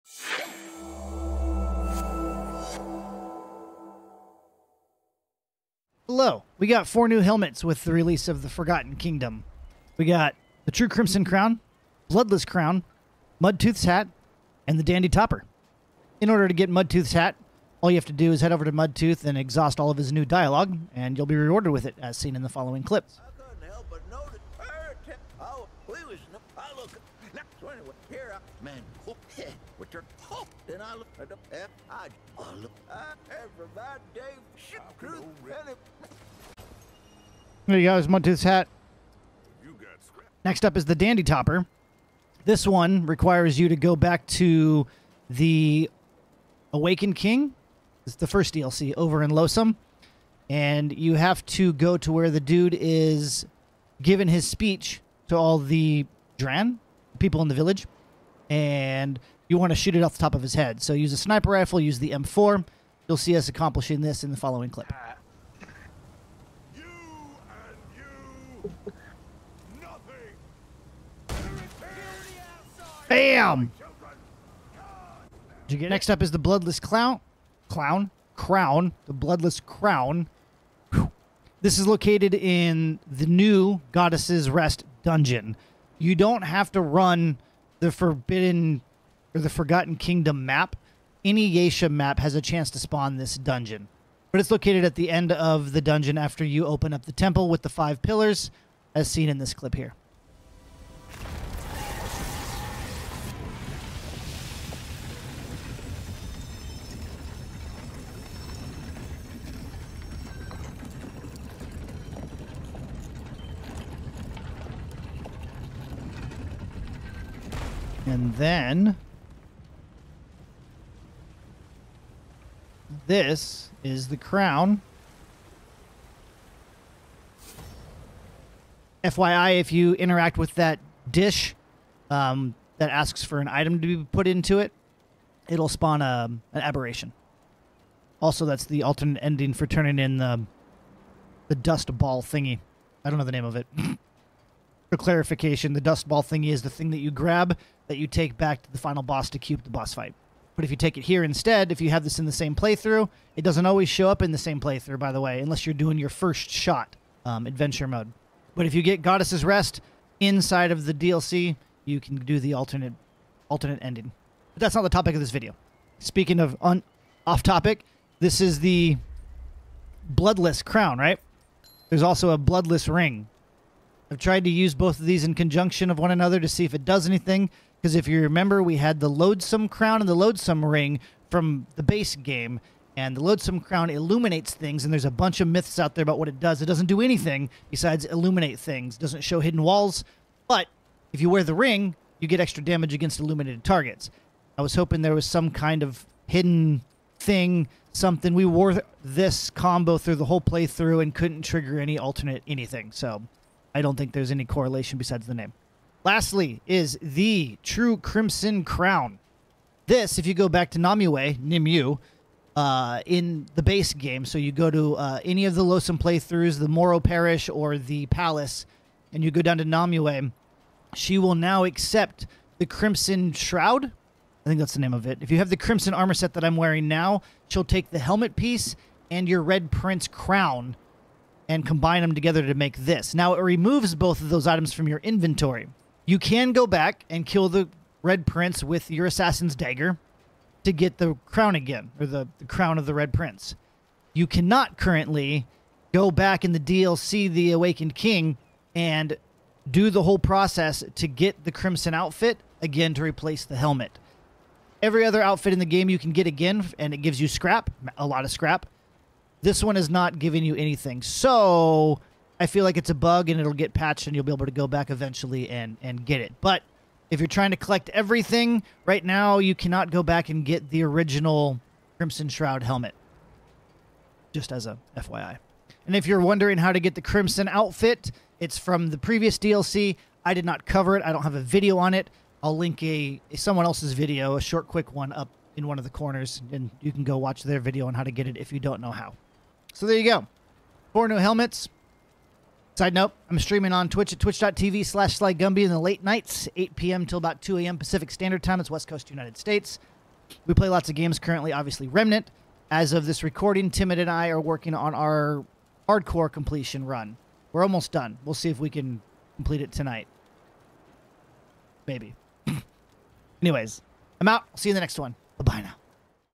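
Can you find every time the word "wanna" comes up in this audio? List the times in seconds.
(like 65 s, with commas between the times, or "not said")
not said.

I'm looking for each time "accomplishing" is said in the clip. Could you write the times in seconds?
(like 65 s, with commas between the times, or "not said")
63 s.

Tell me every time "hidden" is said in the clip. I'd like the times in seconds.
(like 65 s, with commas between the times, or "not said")
189 s, 196 s.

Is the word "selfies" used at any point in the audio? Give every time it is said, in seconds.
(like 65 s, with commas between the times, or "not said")
not said.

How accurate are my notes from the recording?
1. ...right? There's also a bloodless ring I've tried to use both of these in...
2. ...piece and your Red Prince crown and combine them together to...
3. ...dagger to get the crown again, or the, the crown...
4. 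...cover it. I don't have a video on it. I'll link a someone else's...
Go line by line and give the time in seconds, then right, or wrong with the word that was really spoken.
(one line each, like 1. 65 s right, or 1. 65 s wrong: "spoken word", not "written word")
1. 170 s right
2. 228 s right
3. 239 s right
4. 280 s right.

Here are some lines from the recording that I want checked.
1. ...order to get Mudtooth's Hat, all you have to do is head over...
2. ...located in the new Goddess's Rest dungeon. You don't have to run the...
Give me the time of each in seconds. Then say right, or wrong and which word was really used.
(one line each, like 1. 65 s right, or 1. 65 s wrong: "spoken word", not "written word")
1. 16 s right
2. 81 s right.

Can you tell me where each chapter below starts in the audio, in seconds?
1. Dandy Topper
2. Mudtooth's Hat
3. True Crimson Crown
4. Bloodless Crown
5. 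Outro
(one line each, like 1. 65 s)
1. 40 s
2. 15 s
3. 205 s
4. 75 s
5. 289 s.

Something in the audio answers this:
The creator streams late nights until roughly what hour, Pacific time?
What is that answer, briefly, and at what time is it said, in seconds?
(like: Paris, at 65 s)
2 a.m., at 297 s.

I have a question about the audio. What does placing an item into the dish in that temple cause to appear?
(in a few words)
An aberration.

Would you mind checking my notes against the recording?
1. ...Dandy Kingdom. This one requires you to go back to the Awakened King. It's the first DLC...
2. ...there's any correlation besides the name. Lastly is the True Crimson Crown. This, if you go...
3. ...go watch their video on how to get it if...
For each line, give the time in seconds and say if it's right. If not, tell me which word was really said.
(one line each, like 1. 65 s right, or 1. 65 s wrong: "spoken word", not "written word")
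1. 40 s wrong: "Topper", not "Kingdom"
2. 204 s right
3. 287 s right.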